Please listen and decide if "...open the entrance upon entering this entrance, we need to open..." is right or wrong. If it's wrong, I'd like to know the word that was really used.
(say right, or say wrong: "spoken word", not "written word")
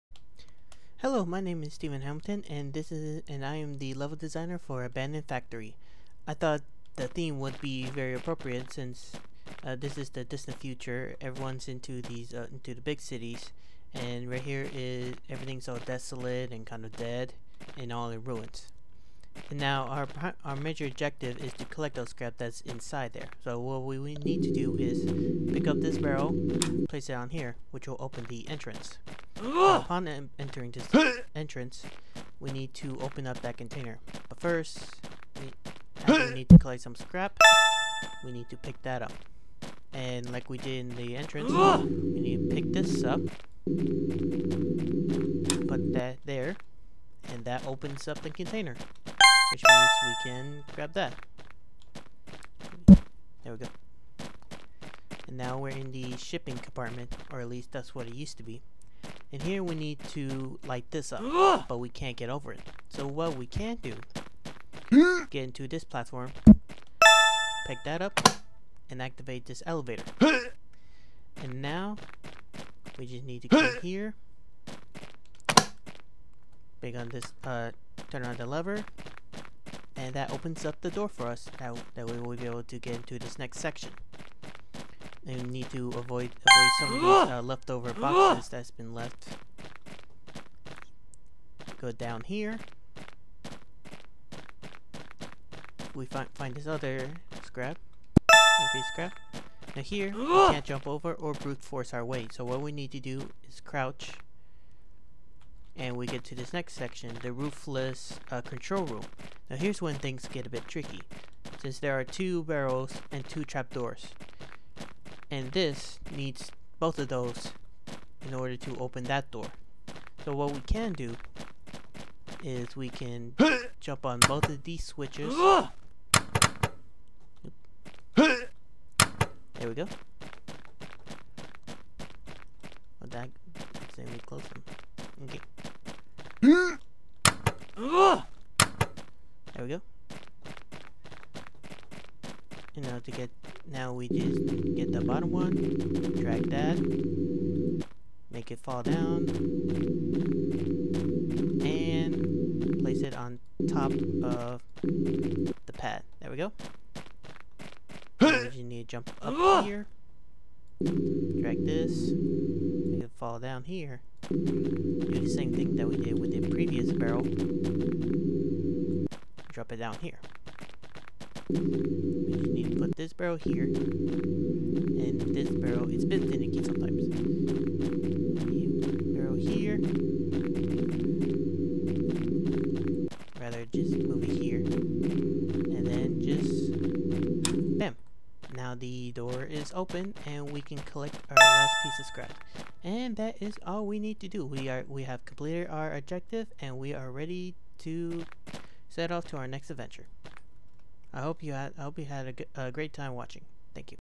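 right.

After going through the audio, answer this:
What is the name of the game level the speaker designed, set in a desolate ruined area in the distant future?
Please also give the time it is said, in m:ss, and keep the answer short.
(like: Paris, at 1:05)
Abandoned Factory, at 0:04.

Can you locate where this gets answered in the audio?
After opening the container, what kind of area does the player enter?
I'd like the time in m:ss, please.
0:56.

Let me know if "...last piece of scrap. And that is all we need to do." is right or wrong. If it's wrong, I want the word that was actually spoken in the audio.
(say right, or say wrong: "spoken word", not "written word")
right.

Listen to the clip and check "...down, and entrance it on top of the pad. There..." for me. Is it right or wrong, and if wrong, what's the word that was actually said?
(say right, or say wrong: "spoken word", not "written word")
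wrong: "place", not "entrance".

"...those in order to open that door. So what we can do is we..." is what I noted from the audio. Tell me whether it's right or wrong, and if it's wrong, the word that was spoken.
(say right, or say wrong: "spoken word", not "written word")
right.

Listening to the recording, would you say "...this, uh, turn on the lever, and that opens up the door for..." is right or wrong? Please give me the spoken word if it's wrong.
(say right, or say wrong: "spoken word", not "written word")
right.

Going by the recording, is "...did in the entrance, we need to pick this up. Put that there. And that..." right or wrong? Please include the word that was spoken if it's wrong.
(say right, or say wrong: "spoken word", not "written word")
right.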